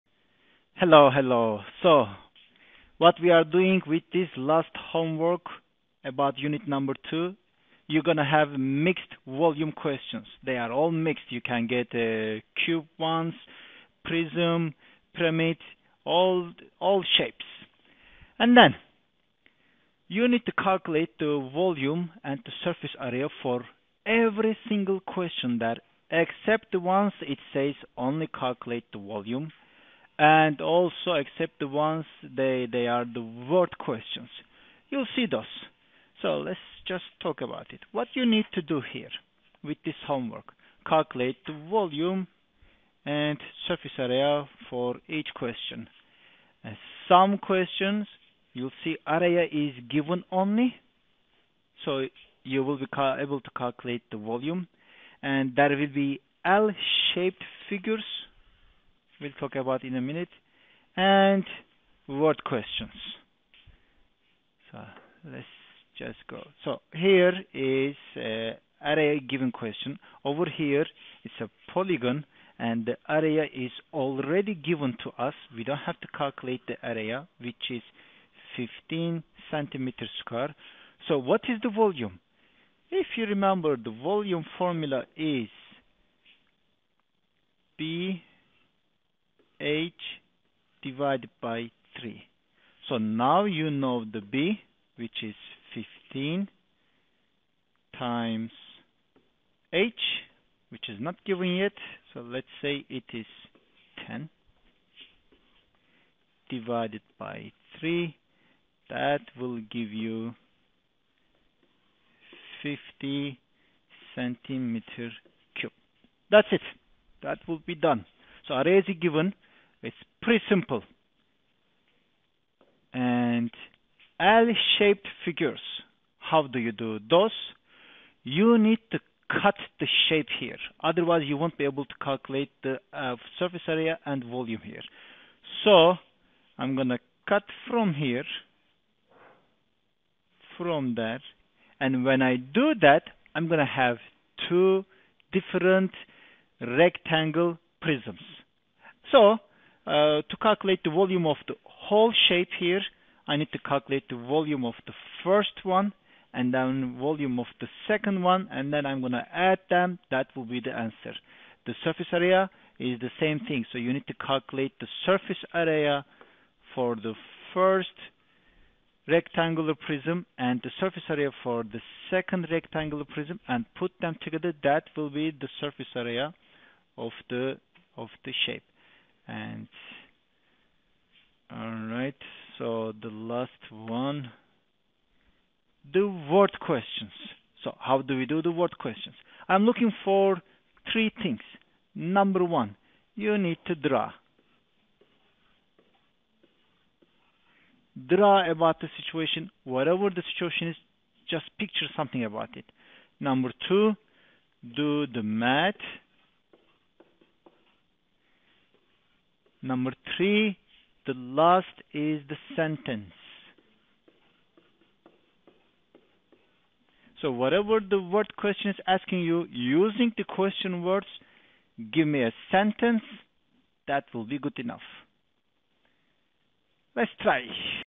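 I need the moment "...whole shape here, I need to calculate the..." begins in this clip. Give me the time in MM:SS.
02:31.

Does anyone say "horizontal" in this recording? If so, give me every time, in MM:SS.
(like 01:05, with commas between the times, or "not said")
not said.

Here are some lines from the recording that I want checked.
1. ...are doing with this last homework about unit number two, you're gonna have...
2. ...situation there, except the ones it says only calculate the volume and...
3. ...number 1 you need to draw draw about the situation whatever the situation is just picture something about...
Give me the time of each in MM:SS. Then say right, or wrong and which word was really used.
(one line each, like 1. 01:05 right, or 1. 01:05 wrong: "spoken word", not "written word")
1. 00:03 right
2. 00:24 wrong: "question", not "situation"
3. 03:11 right.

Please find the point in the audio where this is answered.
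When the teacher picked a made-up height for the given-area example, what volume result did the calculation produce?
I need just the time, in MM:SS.
01:52.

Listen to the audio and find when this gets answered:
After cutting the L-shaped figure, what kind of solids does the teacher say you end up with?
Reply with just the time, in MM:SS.
02:26.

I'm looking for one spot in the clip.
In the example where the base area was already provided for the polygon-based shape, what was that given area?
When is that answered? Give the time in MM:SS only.
01:18.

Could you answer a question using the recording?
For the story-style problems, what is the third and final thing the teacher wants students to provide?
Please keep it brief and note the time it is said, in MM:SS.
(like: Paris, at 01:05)
a sentence, at 03:32.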